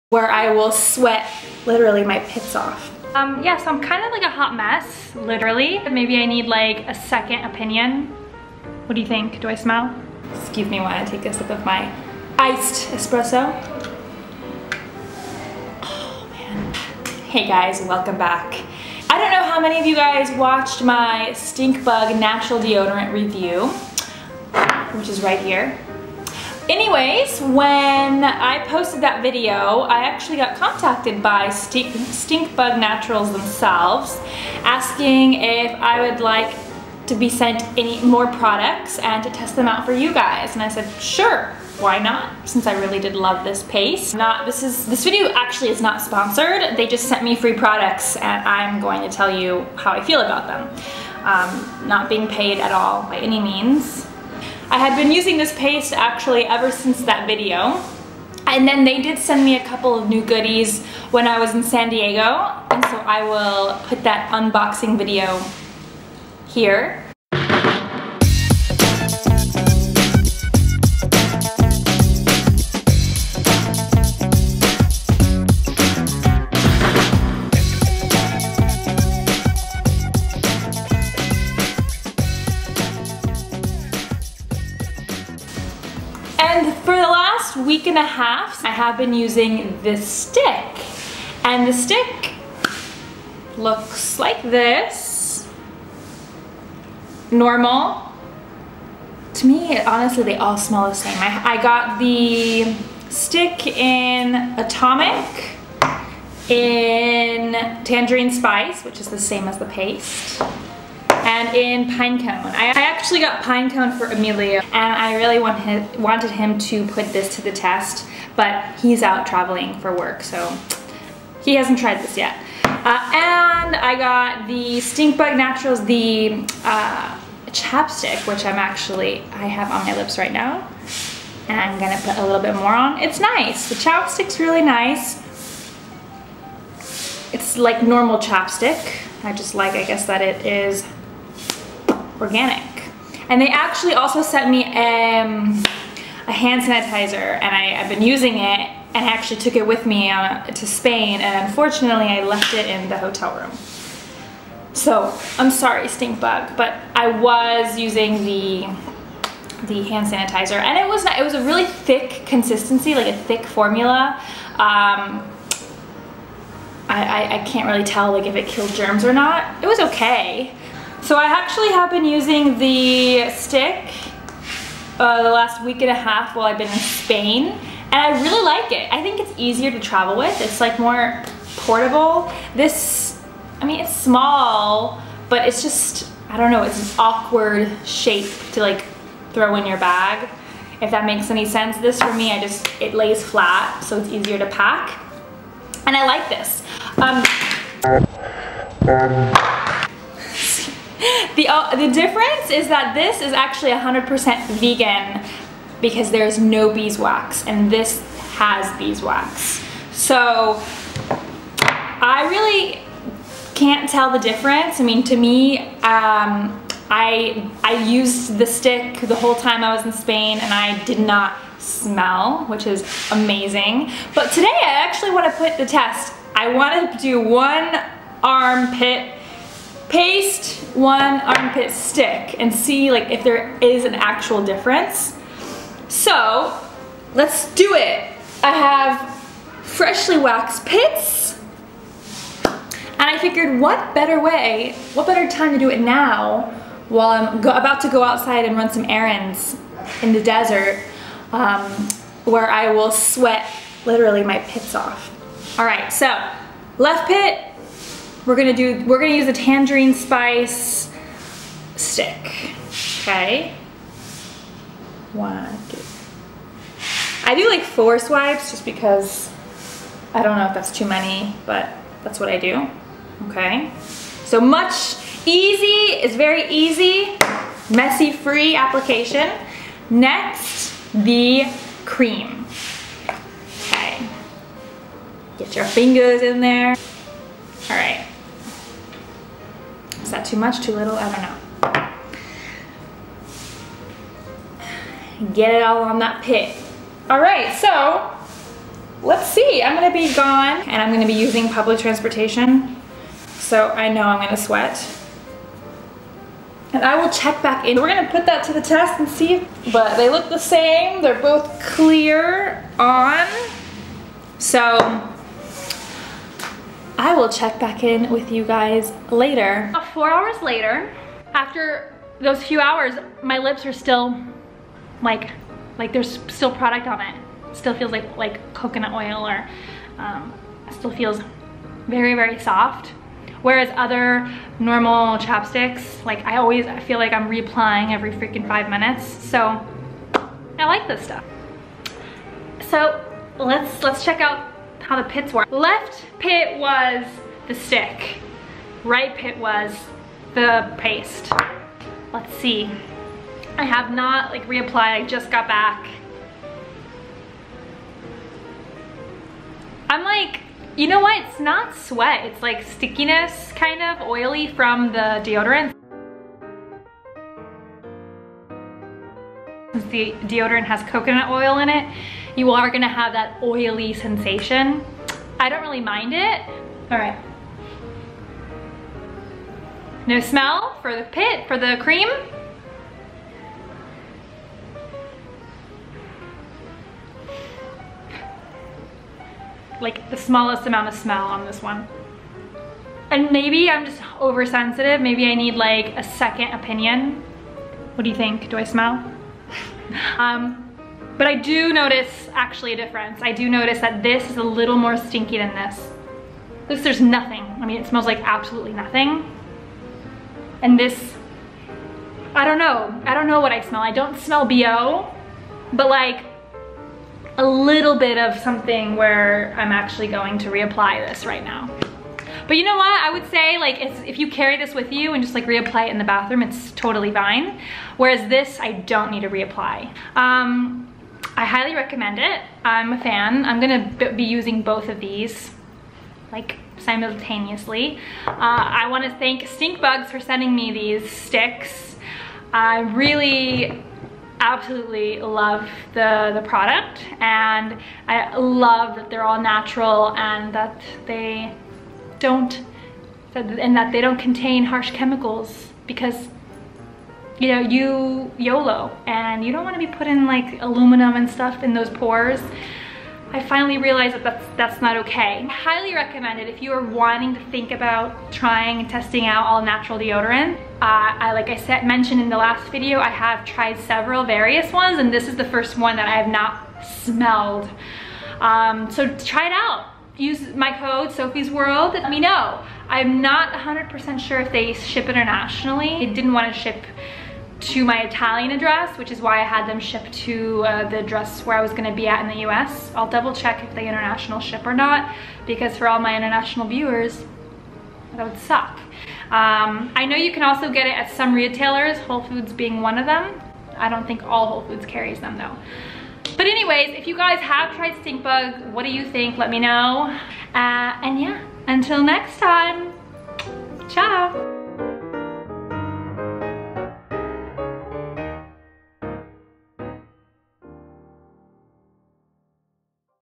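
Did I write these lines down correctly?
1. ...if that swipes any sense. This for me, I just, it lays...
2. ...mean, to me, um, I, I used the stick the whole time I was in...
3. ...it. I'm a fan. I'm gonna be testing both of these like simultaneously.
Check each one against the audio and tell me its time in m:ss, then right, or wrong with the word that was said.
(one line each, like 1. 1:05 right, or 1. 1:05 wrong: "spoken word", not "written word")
1. 3:10 wrong: "makes", not "swipes"
2. 3:34 right
3. 7:12 wrong: "using", not "testing".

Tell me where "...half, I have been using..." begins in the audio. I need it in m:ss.
1:28.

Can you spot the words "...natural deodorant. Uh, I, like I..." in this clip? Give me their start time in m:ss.
7:49.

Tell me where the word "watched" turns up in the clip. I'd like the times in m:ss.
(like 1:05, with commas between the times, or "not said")
0:20.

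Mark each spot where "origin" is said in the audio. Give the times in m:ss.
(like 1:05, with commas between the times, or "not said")
not said.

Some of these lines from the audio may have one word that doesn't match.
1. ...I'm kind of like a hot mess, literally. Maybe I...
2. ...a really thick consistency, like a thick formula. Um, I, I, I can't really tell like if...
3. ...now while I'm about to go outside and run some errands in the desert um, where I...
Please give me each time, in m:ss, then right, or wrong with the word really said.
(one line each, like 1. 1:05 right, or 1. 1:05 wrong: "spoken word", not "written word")
1. 0:03 right
2. 2:41 right
3. 4:05 right.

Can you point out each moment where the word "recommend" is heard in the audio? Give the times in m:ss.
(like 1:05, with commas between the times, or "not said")
7:11, 7:45.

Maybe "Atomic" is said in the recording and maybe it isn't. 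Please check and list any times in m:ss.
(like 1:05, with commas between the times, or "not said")
1:44.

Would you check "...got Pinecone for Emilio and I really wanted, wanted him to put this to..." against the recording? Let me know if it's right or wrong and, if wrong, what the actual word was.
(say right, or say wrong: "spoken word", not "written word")
right.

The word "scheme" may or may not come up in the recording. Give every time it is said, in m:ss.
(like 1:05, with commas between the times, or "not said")
not said.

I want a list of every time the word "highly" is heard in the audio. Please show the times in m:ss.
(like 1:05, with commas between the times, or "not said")
7:11, 7:45.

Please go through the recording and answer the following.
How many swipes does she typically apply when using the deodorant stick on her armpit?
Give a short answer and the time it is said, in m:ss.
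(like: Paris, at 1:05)
4, at 4:27.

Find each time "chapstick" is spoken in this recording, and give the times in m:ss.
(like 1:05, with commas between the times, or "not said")
2:07, 2:13, 2:18, 5:35.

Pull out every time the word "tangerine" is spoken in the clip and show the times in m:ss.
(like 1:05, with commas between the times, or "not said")
1:47, 4:19.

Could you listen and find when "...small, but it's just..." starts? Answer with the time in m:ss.
3:03.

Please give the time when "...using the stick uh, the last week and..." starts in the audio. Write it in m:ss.
2:52.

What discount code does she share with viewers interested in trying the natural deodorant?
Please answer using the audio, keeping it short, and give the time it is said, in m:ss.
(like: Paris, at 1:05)
Sofie's World, at 8:01.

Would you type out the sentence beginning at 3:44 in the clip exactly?
But today I actually want to put the test.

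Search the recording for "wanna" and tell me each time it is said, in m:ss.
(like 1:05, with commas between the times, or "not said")
7:18, 7:39.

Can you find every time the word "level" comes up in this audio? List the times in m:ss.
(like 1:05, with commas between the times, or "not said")
not said.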